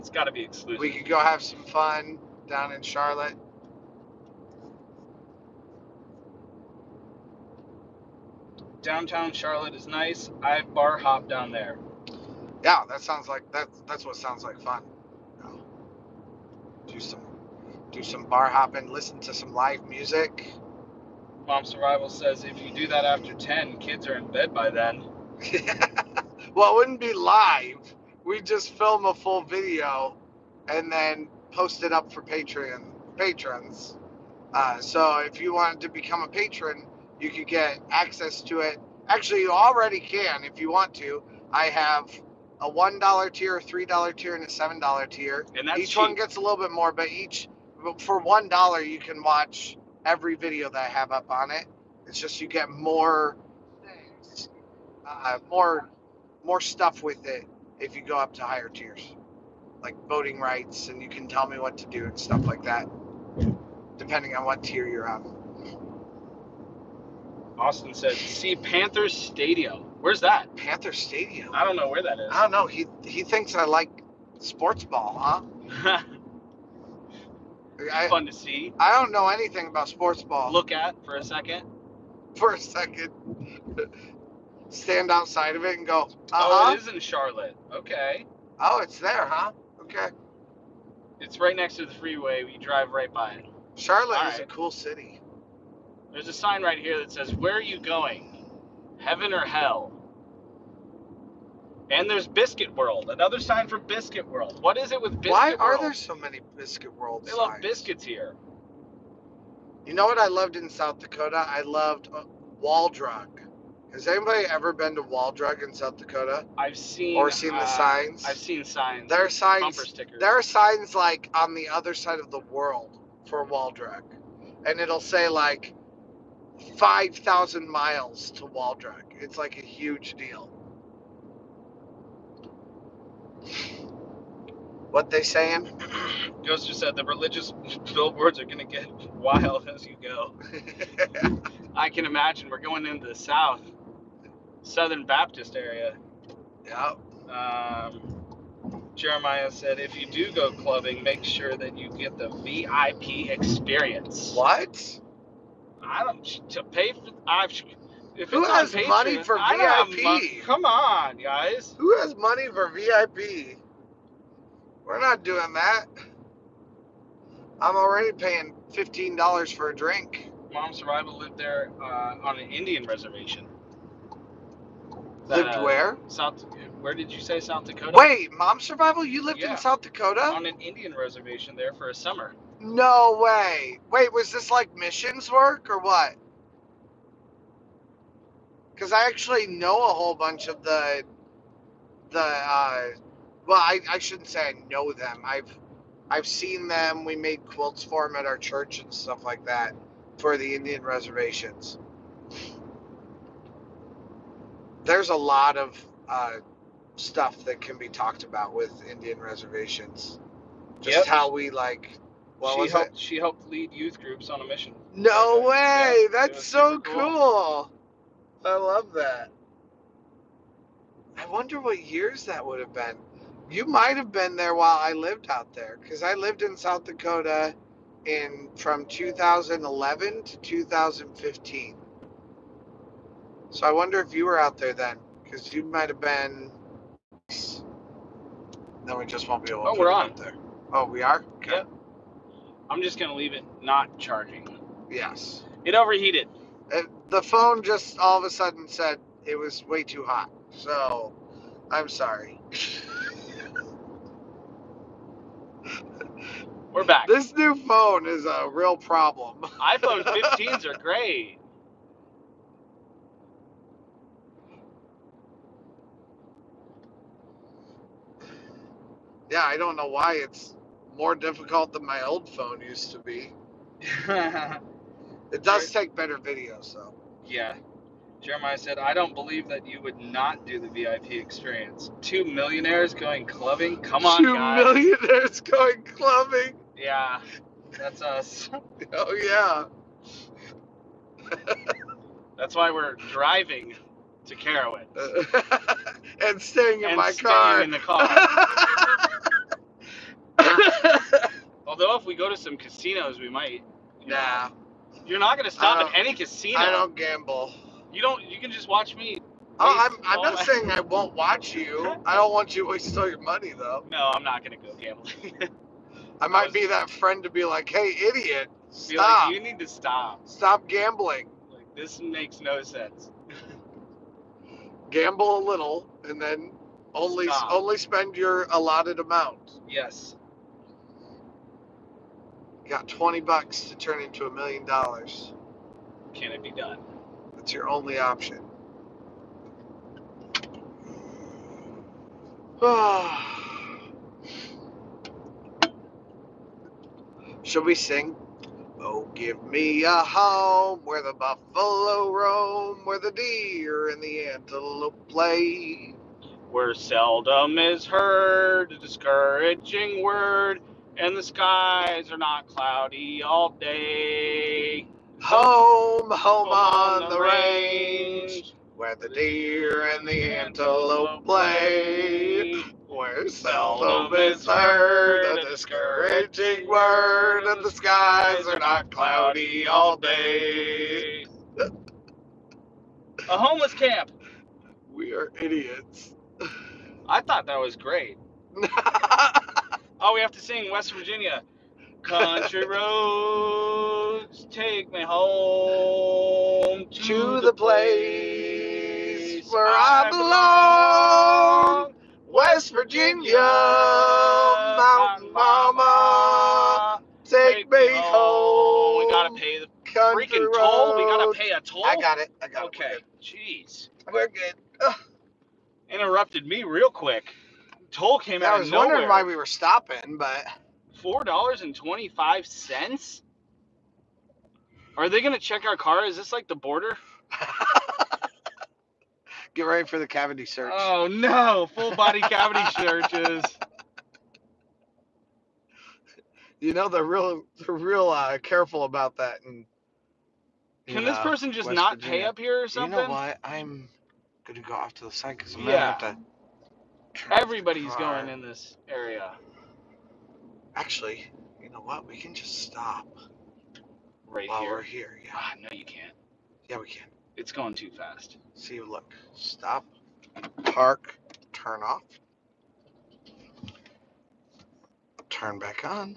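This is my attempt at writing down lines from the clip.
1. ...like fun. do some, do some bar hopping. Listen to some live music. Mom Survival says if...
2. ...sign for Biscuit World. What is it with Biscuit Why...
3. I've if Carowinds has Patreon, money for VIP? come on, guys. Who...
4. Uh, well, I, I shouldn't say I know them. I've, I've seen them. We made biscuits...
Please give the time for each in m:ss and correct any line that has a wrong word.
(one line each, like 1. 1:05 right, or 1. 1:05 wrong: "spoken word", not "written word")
1. 0:14 right
2. 1:43 right
3. 2:37 wrong: "Who", not "Carowinds"
4. 3:12 wrong: "quilts", not "biscuits".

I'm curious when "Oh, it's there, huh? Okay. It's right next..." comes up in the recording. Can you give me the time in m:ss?
1:28.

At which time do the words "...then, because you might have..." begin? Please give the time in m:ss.
3:54.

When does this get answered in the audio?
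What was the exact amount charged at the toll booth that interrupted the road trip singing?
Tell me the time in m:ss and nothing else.
7:00.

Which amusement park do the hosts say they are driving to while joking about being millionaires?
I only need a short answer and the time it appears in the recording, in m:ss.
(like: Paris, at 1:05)
Carowinds, at 4:54.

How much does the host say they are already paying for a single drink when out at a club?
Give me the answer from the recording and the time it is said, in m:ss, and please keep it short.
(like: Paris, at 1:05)
$15, at 2:48.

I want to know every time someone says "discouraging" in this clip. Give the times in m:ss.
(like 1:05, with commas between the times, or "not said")
5:58, 6:15.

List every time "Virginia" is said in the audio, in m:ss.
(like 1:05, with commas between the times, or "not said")
6:30, 6:42, 7:21.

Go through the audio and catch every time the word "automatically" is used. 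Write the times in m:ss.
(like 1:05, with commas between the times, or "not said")
not said.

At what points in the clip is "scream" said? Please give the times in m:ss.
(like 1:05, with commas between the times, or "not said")
not said.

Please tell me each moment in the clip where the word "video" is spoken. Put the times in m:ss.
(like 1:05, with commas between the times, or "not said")
0:29, 0:50, 4:36.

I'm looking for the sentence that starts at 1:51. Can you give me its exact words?
I loved uh, Wall has anybody ever been to Waldrug in South Dakota?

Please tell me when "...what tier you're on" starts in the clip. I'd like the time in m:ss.
1:04.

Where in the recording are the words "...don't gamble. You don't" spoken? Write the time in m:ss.
5:06.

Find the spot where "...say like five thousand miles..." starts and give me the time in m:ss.
2:04.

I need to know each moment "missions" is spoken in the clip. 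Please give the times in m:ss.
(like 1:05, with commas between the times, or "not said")
3:04, 3:34.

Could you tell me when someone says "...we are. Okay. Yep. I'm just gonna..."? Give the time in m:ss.
4:00.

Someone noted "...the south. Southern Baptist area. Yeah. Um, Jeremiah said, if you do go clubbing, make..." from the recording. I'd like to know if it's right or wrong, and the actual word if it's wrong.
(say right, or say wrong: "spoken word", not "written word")
right.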